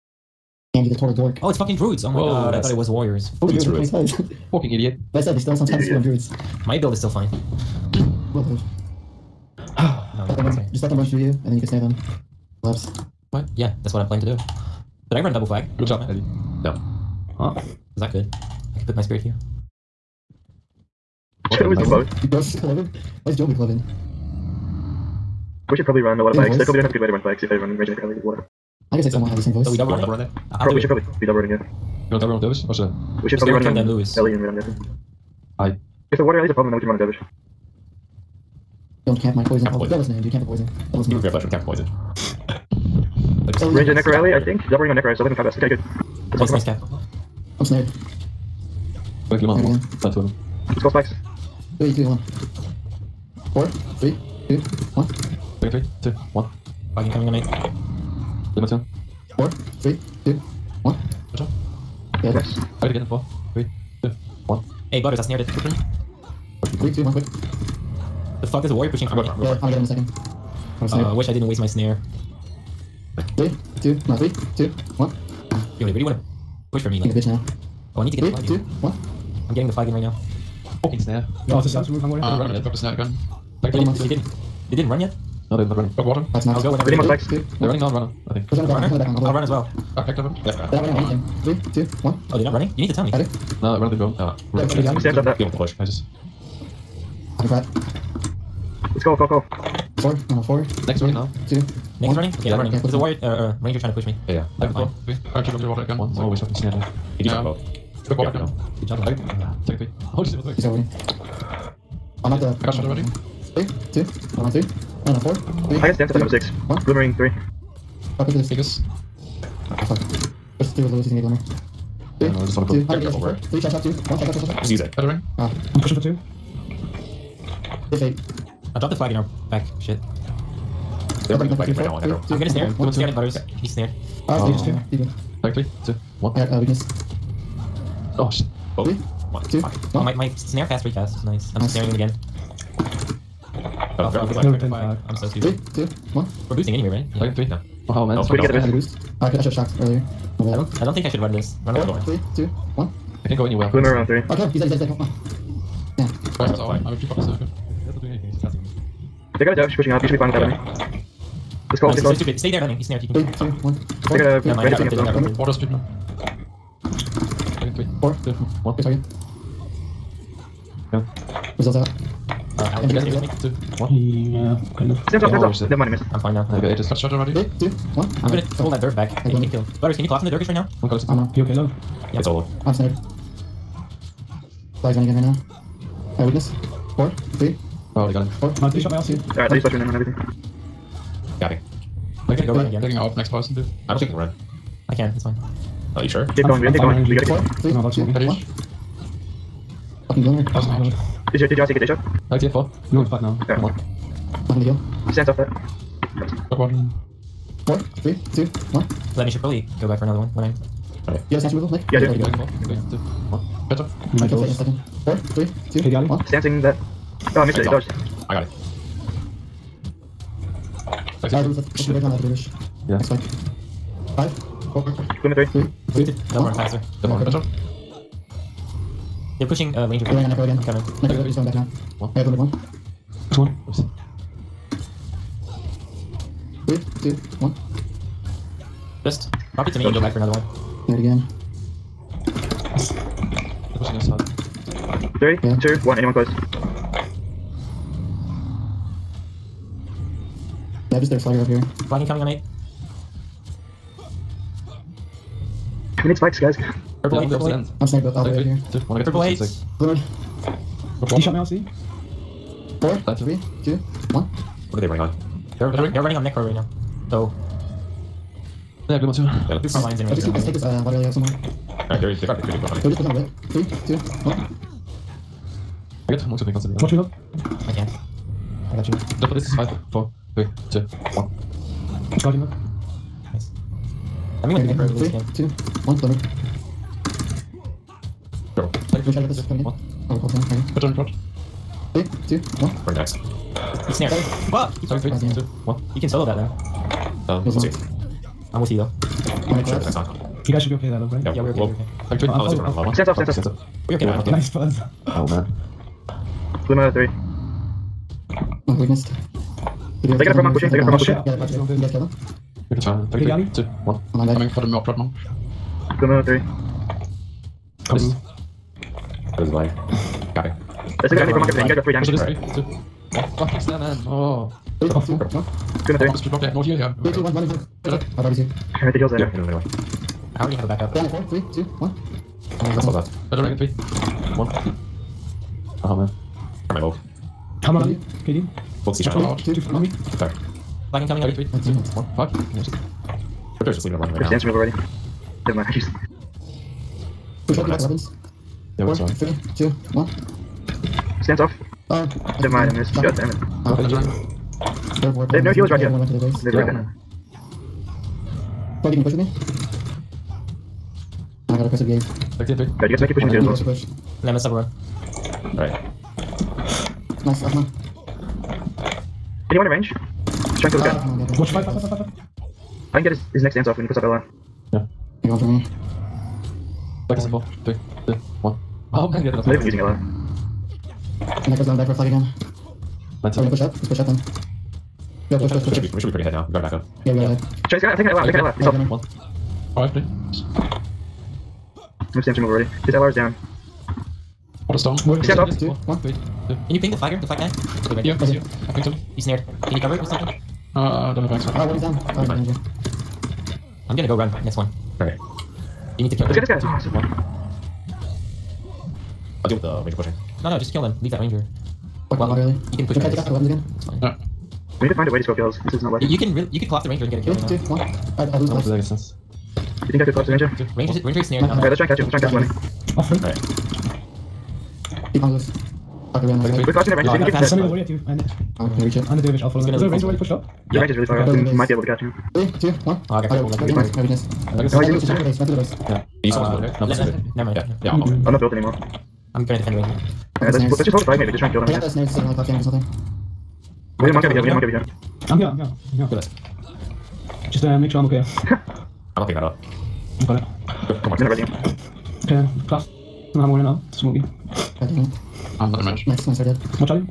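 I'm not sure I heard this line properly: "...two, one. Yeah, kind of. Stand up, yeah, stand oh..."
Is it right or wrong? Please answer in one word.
right.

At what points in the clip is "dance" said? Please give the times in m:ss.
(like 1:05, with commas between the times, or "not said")
5:44, 6:13.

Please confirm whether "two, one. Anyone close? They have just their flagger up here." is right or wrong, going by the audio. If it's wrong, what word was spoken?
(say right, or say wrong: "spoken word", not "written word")
right.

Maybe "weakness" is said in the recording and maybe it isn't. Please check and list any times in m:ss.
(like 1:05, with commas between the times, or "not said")
2:16, 3:06, 5:08, 7:14.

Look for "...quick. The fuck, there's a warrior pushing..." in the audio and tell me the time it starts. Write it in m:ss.
1:07.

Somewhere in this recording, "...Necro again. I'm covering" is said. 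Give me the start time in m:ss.
3:50.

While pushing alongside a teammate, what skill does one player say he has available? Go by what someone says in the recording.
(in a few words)
Oppressive gaze.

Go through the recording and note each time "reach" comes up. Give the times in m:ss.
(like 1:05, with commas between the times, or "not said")
7:08.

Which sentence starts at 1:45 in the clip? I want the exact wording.
I keep up the water again.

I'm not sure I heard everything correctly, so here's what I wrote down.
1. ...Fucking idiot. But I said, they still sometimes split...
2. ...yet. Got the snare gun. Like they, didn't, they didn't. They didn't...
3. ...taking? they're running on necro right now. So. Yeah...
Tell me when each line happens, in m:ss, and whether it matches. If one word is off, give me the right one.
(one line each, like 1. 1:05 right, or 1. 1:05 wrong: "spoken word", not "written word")
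1. 0:04 right
2. 1:22 right
3. 4:25 wrong: "running", not "taking".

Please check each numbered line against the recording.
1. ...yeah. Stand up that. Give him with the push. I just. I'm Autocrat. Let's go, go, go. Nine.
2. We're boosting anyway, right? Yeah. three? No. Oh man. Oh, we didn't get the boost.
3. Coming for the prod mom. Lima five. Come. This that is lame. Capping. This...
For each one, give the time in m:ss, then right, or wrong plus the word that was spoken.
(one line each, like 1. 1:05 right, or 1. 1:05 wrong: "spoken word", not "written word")
1. 1:34 wrong: "Four", not "Nine"
2. 2:26 right
3. 5:14 wrong: "three", not "five".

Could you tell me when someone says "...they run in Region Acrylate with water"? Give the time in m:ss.
0:27.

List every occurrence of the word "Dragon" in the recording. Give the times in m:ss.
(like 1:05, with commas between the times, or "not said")
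2:47, 5:33.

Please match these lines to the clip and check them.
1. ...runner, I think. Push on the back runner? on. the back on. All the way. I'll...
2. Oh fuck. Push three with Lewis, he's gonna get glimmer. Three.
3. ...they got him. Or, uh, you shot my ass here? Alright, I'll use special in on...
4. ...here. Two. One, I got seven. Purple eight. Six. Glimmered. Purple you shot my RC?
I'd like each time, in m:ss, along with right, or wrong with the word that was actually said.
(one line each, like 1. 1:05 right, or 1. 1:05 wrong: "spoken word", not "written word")
1. 1:27 right
2. 1:59 right
3. 3:08 right
4. 4:18 wrong: "two", not "seven".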